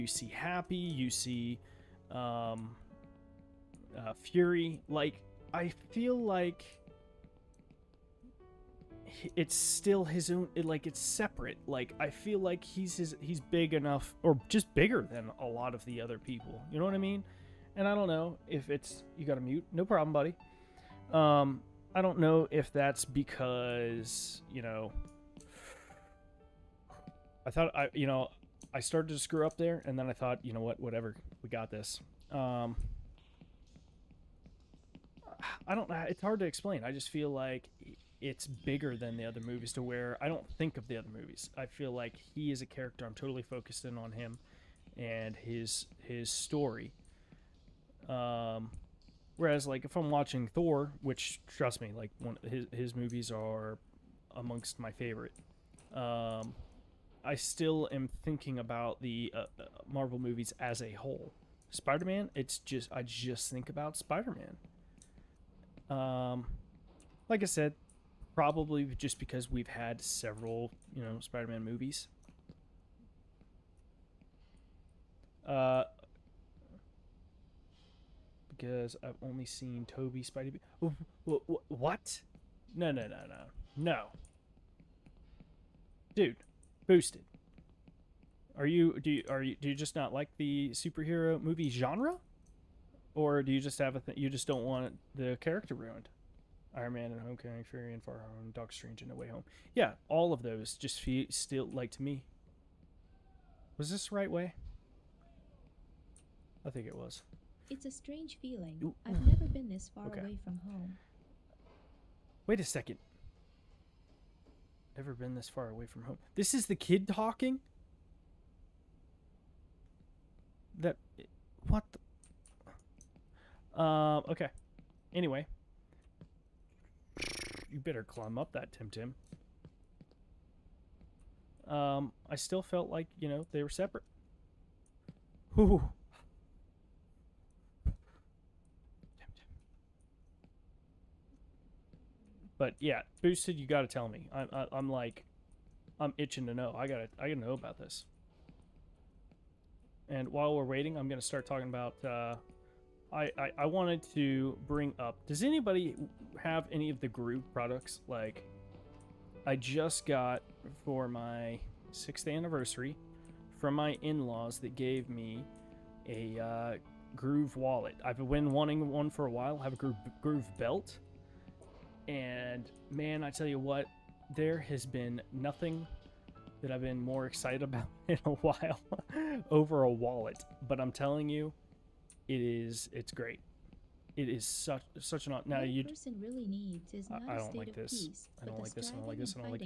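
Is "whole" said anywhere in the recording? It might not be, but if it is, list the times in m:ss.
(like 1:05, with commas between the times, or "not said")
1:00.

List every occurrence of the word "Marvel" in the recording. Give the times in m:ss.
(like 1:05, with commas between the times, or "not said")
0:59.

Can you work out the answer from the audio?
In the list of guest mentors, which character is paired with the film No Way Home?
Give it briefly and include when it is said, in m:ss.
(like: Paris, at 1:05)
Doc Strange, at 1:38.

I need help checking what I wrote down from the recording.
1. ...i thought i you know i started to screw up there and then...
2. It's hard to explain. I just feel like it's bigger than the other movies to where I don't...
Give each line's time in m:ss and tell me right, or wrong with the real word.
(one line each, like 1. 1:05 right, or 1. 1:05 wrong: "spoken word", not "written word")
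1. 0:27 right
2. 0:36 right.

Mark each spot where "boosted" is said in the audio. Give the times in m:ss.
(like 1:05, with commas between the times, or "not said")
1:26, 2:23.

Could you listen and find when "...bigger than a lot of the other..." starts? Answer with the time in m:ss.
0:14.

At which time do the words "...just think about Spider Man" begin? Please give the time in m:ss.
1:03.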